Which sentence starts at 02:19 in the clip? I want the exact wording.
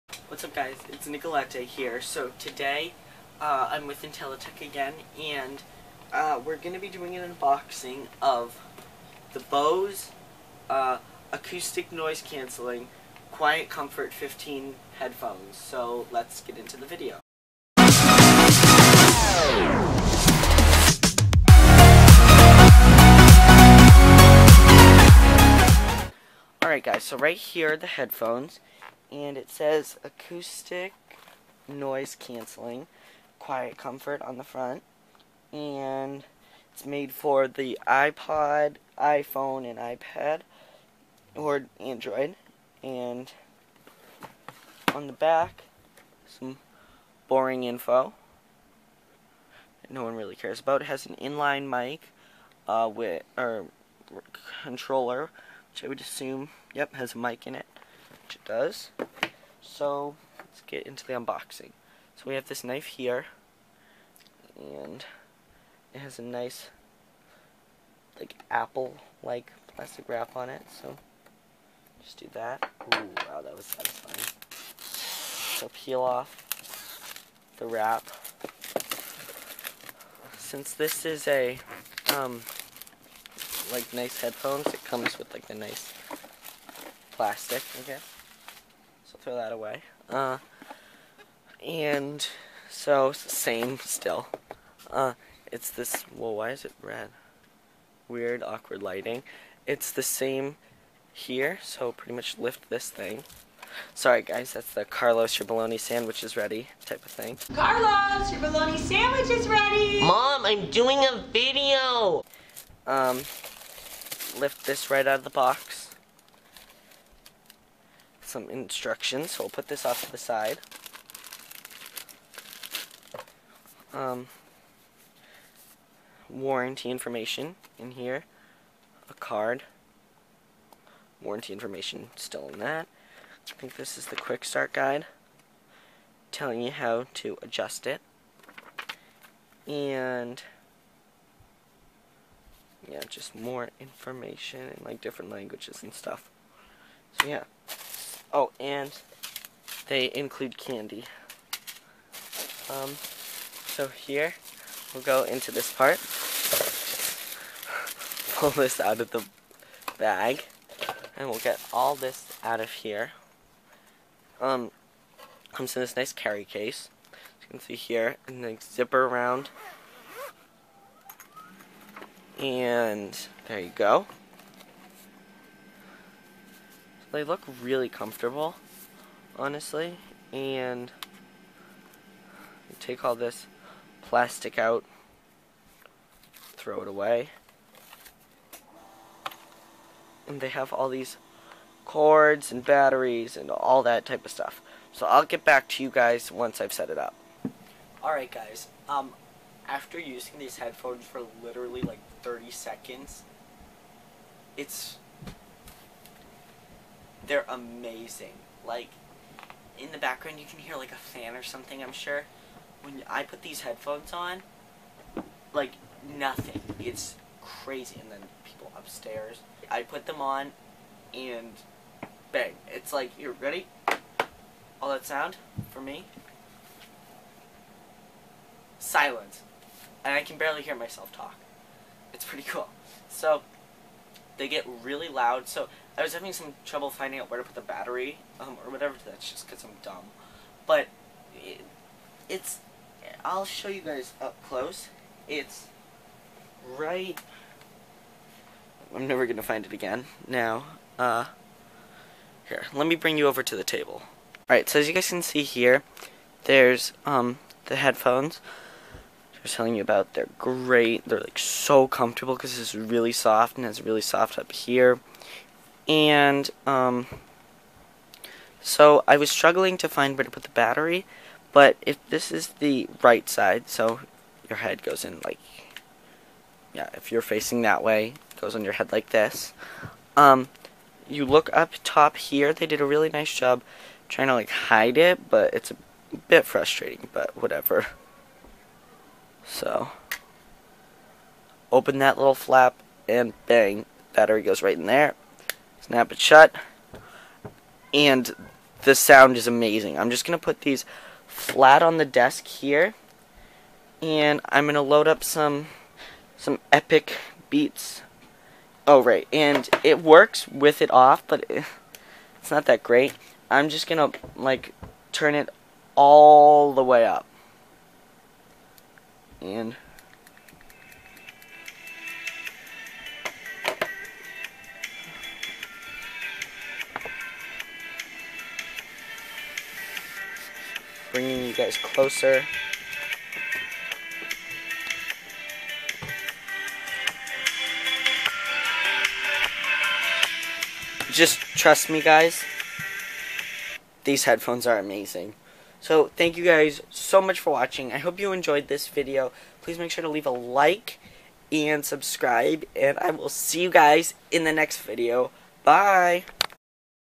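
And yeah, just more information in like different languages and stuff.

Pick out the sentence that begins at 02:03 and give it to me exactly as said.
Um, warranty information in here, a card, warranty information still in that.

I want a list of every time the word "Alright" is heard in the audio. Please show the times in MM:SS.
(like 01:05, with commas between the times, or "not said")
00:26, 03:18.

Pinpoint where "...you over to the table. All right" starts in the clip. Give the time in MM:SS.
04:13.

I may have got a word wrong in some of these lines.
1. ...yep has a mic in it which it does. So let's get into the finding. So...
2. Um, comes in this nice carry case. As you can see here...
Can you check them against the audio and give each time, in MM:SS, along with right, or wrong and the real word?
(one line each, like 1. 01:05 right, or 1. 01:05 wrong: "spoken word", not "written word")
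1. 00:56 wrong: "unboxing", not "finding"
2. 02:44 right.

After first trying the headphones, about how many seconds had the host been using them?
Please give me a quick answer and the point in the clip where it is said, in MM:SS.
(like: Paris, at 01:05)
30, at 03:22.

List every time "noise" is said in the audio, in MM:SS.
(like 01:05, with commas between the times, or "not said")
00:11, 00:31.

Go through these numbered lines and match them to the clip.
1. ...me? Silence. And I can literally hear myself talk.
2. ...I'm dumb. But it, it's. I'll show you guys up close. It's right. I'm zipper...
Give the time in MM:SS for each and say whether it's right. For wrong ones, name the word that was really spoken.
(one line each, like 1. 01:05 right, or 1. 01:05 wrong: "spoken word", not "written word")
1. 03:45 wrong: "barely", not "literally"
2. 03:59 wrong: "never", not "zipper".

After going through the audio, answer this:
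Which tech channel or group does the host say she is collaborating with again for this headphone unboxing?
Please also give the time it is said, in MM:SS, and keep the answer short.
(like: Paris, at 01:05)
IntelliTech, at 00:04.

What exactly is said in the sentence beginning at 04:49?
So, open that little flap, and bang, battery goes right in there.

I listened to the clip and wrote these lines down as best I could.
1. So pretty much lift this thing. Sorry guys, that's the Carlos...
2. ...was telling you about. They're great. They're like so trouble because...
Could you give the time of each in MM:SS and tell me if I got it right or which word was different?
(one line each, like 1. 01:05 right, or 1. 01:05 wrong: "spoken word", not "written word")
1. 01:41 right
2. 04:19 wrong: "comfortable", not "trouble".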